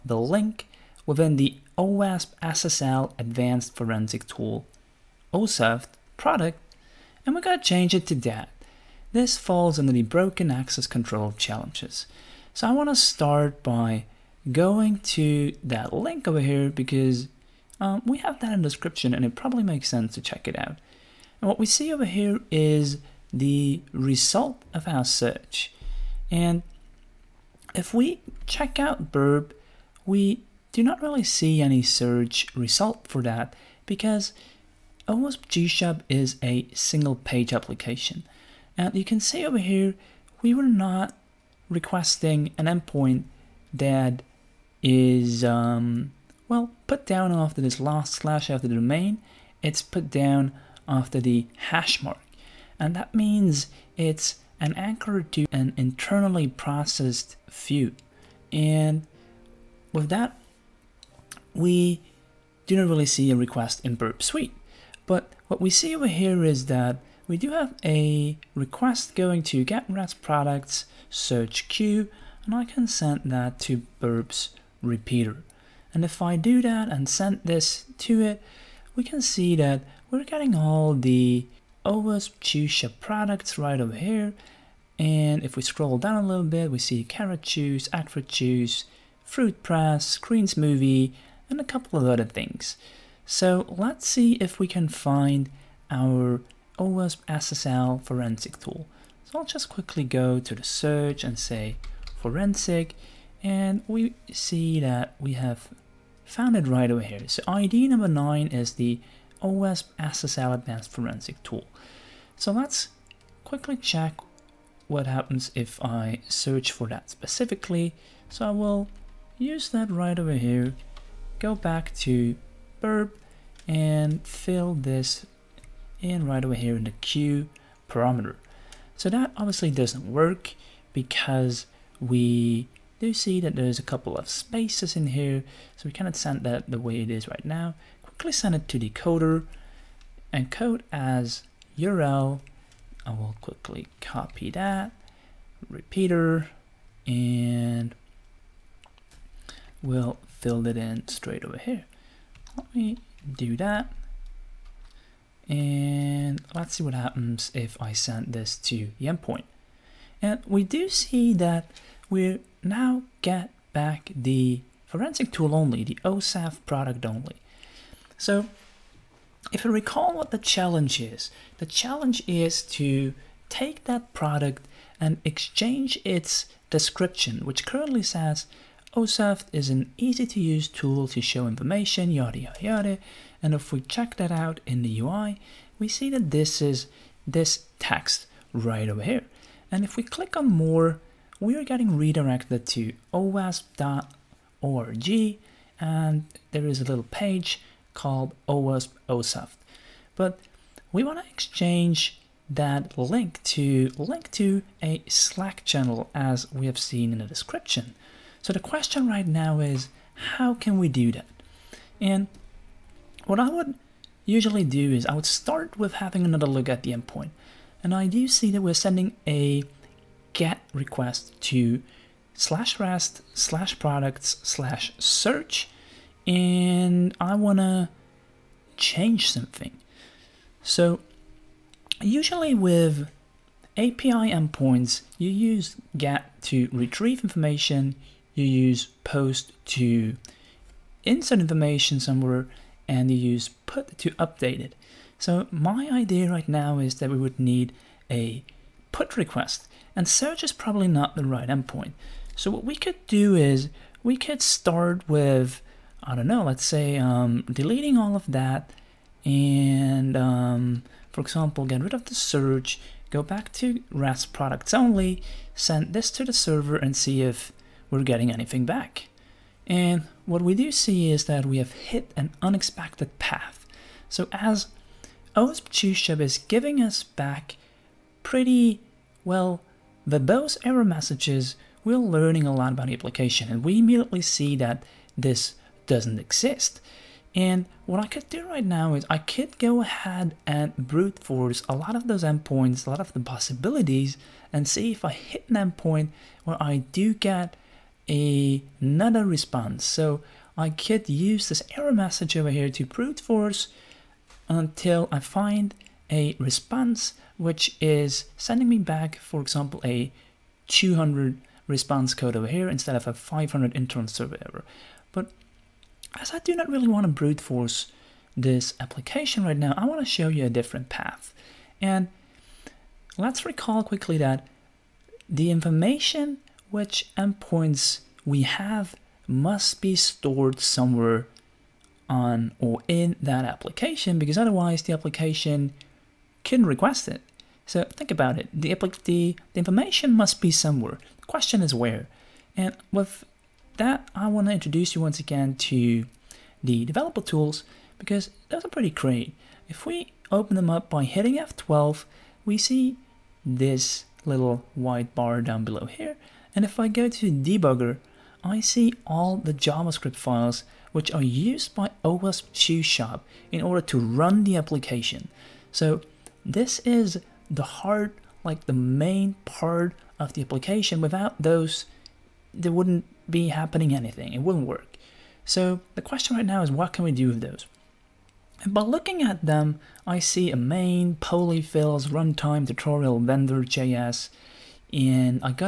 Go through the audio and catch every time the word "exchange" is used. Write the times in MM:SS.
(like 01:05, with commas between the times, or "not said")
02:55, 03:21.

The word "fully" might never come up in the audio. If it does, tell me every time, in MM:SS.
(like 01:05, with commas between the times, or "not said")
not said.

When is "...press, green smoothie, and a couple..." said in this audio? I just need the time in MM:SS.
01:29.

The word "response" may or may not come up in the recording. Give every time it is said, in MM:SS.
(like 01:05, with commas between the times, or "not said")
04:59, 05:06, 05:11.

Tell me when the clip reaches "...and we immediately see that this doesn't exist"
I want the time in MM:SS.
04:43.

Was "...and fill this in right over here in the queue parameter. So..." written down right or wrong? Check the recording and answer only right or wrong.
right.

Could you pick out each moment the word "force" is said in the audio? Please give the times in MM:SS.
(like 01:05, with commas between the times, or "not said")
04:51, 05:03, 05:17.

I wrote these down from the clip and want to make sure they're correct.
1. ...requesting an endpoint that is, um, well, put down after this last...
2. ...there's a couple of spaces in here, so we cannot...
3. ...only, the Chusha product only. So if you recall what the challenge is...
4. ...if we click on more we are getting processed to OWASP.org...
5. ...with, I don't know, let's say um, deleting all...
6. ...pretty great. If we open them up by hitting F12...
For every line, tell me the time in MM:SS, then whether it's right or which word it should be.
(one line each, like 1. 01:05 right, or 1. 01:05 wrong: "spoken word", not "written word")
1. 00:41 right
2. 02:13 right
3. 02:45 wrong: "OSAF", not "Chusha"
4. 03:09 wrong: "redirected", not "processed"
5. 04:15 right
6. 05:48 right.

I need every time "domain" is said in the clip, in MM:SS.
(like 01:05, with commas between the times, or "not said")
00:48.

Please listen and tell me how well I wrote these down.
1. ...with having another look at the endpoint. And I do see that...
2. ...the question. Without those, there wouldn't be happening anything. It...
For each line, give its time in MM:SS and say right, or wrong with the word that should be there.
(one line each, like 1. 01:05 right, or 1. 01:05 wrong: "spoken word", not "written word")
1. 03:35 right
2. 06:10 wrong: "application", not "question".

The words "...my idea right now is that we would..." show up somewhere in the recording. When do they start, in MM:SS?
04:05.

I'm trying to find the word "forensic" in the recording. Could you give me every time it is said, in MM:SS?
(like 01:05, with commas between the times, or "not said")
00:03, 01:38, 01:42, 01:50, 02:44.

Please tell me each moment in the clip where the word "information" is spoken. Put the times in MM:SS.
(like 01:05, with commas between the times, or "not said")
03:01, 03:57, 04:01, 05:25, 05:39.